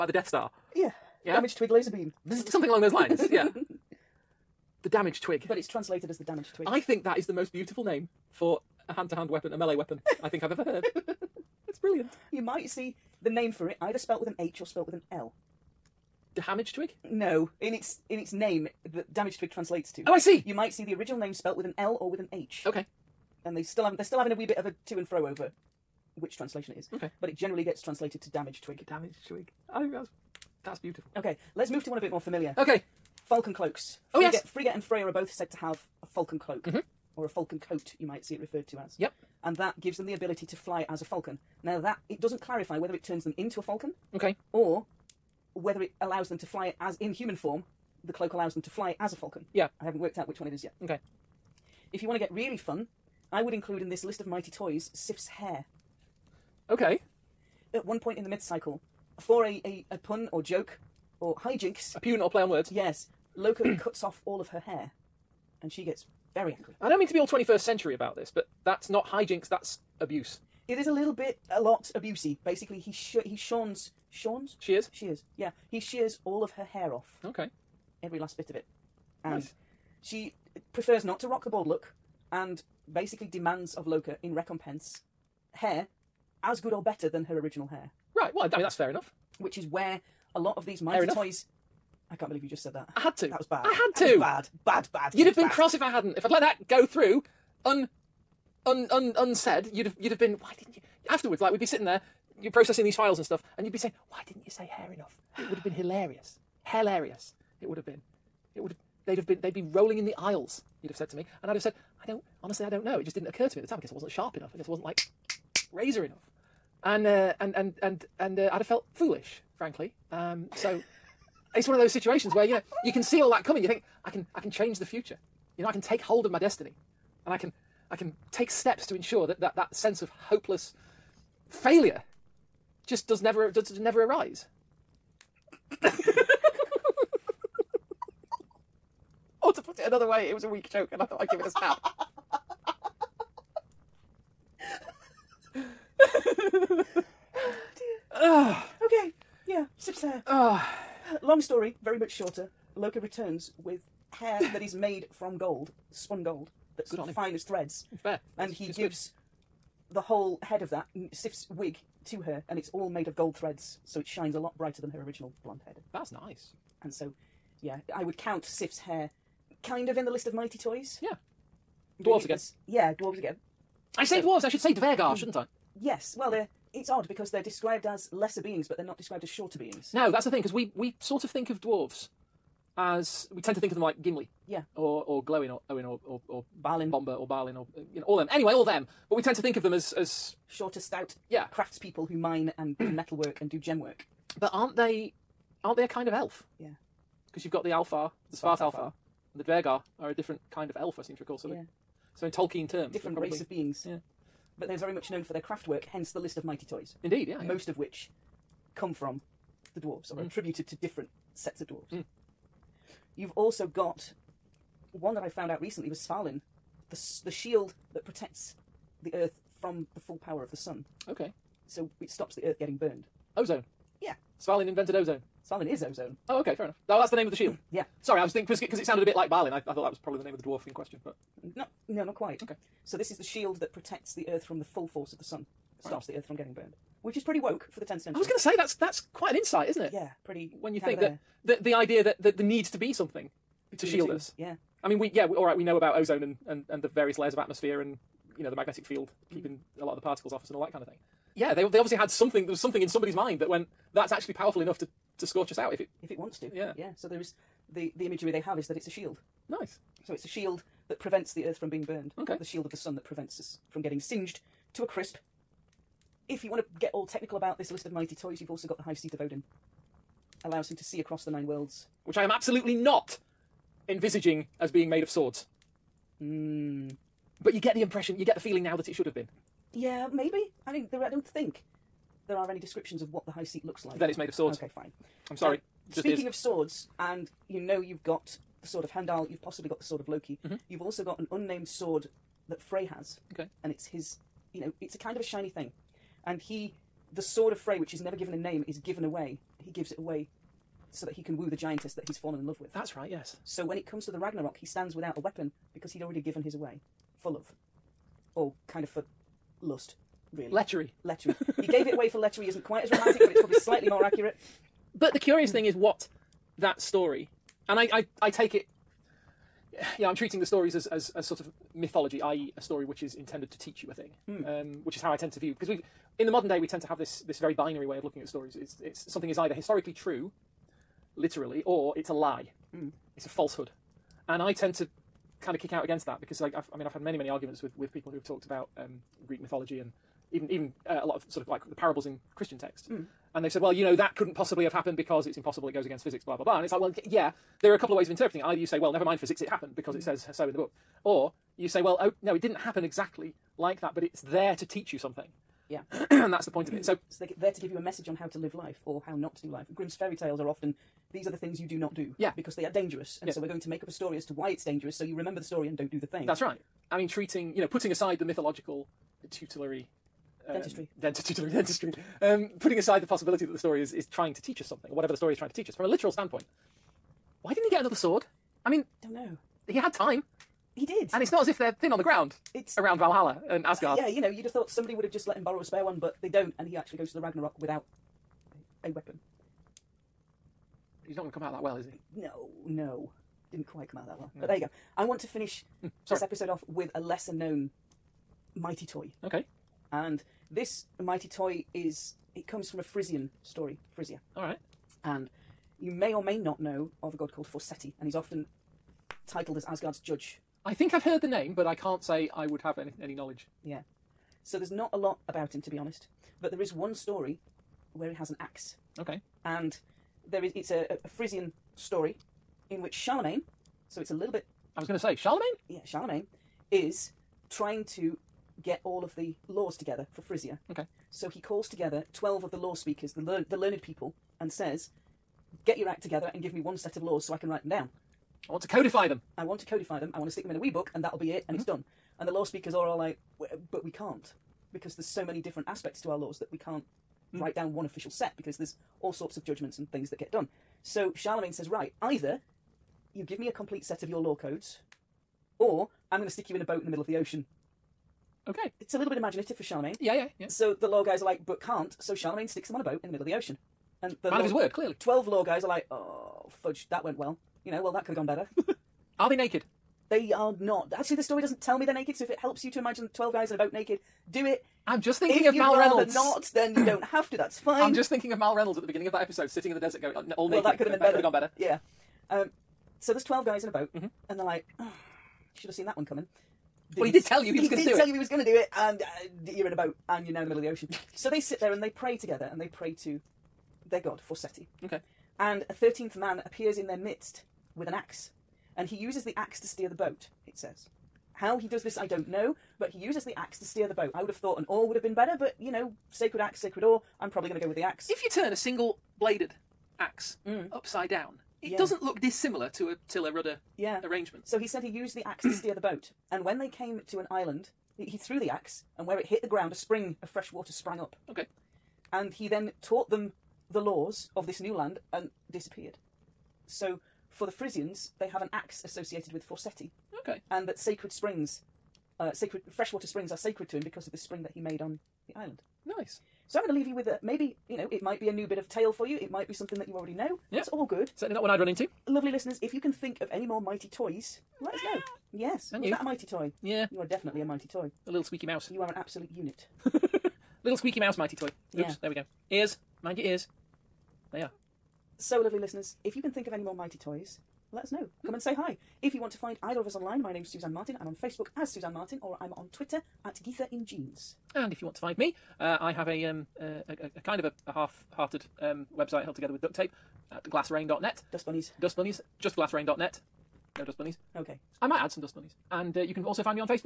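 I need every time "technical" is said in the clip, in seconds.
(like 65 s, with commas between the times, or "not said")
267 s.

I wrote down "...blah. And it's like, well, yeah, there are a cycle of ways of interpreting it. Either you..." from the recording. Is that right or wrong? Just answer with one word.
wrong.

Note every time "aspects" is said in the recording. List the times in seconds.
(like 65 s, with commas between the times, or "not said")
445 s.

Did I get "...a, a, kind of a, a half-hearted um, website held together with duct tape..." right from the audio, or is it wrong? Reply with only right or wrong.
right.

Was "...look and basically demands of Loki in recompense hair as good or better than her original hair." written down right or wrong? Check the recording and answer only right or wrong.
right.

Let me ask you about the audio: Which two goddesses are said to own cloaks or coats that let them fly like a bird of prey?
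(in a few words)
Frigga and Freya.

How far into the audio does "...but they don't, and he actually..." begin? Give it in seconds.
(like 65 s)
385 s.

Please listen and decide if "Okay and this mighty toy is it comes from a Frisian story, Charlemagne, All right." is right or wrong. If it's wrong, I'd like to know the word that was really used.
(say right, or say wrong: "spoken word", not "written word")
wrong: "Frisia", not "Charlemagne".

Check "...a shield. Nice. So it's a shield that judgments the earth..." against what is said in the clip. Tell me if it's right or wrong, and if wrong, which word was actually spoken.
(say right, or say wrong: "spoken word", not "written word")
wrong: "prevents", not "judgments".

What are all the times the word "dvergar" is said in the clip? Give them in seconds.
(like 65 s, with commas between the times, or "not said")
174 s, 199 s.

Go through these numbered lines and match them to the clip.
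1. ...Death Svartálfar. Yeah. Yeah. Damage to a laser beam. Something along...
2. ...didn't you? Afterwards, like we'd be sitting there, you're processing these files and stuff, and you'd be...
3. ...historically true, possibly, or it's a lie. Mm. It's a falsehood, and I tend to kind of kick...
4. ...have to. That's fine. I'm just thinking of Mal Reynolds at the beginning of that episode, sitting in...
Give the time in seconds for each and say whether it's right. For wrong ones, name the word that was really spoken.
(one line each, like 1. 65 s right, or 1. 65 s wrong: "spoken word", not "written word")
1. 0 s wrong: "Star", not "Svartálfar"
2. 100 s right
3. 329 s wrong: "literally", not "possibly"
4. 477 s right.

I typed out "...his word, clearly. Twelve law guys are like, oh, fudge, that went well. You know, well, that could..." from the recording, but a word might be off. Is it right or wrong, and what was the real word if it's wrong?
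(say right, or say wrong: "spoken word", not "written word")
right.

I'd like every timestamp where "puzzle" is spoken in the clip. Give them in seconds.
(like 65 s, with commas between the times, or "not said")
not said.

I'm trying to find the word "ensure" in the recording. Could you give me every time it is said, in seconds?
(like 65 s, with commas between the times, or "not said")
128 s.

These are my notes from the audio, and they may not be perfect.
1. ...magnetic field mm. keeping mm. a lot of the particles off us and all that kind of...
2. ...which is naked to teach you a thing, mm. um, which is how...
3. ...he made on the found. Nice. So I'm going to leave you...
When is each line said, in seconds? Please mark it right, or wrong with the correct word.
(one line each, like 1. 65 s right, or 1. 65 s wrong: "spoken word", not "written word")
1. 248 s right
2. 322 s wrong: "intended", not "naked"
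3. 534 s wrong: "island", not "found".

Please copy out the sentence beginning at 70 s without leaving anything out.
It is a little bit, a lot abusey.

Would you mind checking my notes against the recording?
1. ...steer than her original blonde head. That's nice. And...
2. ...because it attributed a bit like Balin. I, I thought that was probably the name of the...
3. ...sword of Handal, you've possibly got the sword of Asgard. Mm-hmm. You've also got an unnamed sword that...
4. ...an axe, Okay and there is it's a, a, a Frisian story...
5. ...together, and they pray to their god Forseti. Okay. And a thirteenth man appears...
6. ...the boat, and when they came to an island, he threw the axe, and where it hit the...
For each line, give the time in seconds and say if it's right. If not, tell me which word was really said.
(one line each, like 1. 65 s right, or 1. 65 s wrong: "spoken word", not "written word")
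1. 164 s wrong: "brighter", not "steer"
2. 228 s wrong: "sounded", not "attributed"
3. 288 s wrong: "Loki", not "Asgard"
4. 418 s right
5. 492 s right
6. 515 s right.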